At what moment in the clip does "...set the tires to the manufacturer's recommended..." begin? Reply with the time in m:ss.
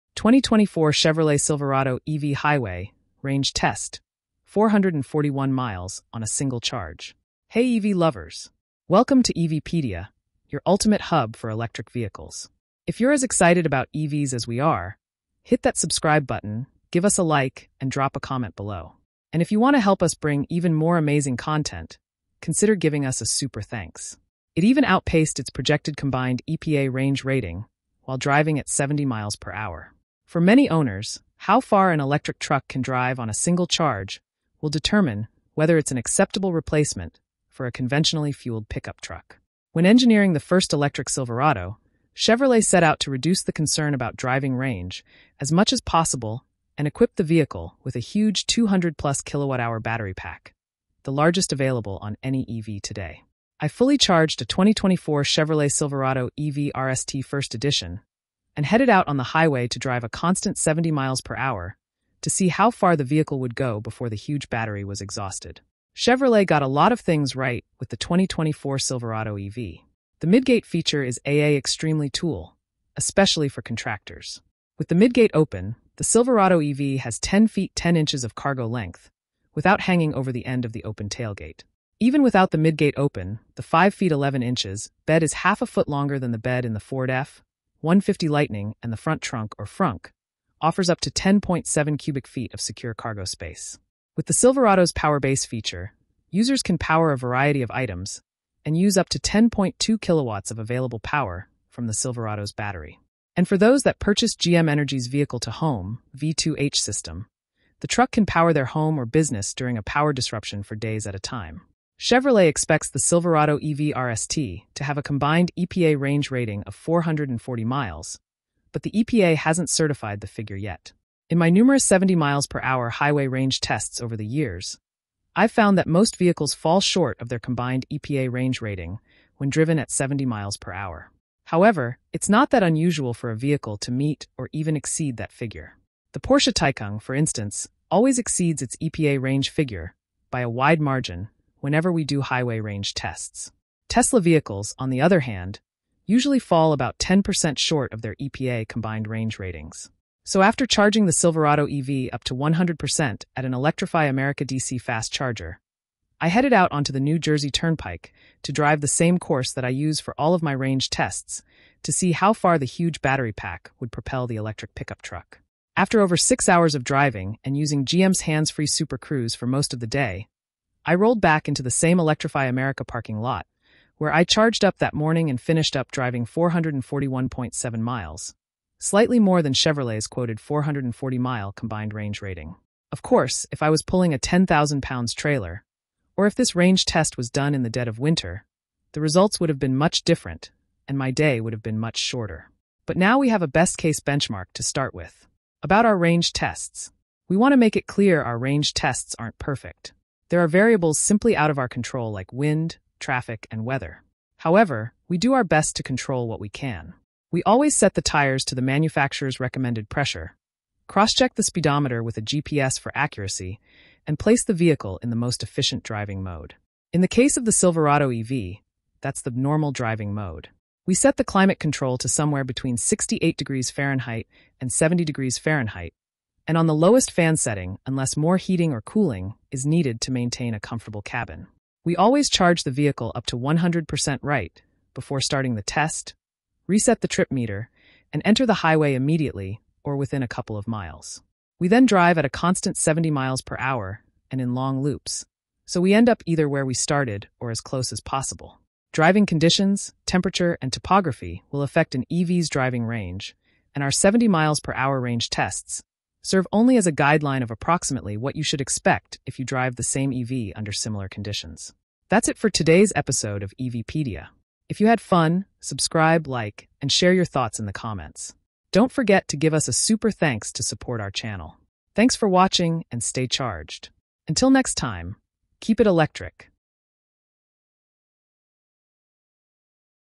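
3:27.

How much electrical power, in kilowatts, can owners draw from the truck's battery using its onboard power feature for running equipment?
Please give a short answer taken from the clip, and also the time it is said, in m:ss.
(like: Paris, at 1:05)
10.2 kilowatts, at 1:39.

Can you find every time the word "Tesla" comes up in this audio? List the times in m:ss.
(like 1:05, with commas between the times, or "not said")
2:23.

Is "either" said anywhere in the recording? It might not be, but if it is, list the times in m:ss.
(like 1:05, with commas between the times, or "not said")
4:06.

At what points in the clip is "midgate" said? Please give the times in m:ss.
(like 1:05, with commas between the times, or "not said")
1:10, 1:14, 1:22.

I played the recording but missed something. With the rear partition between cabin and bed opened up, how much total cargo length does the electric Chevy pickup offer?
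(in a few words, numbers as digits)
10 feet 10 inches.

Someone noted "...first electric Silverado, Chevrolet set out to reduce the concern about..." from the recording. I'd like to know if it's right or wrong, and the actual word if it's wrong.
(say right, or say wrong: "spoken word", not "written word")
right.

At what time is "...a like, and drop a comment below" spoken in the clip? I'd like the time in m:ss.
0:17.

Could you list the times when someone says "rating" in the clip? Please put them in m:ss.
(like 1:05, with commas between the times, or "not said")
0:27, 1:56, 2:08, 2:29, 3:02.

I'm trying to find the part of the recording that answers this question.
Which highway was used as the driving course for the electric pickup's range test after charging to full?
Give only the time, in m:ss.
2:36.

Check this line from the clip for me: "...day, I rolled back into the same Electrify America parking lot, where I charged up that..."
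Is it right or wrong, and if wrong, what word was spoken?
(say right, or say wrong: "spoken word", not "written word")
right.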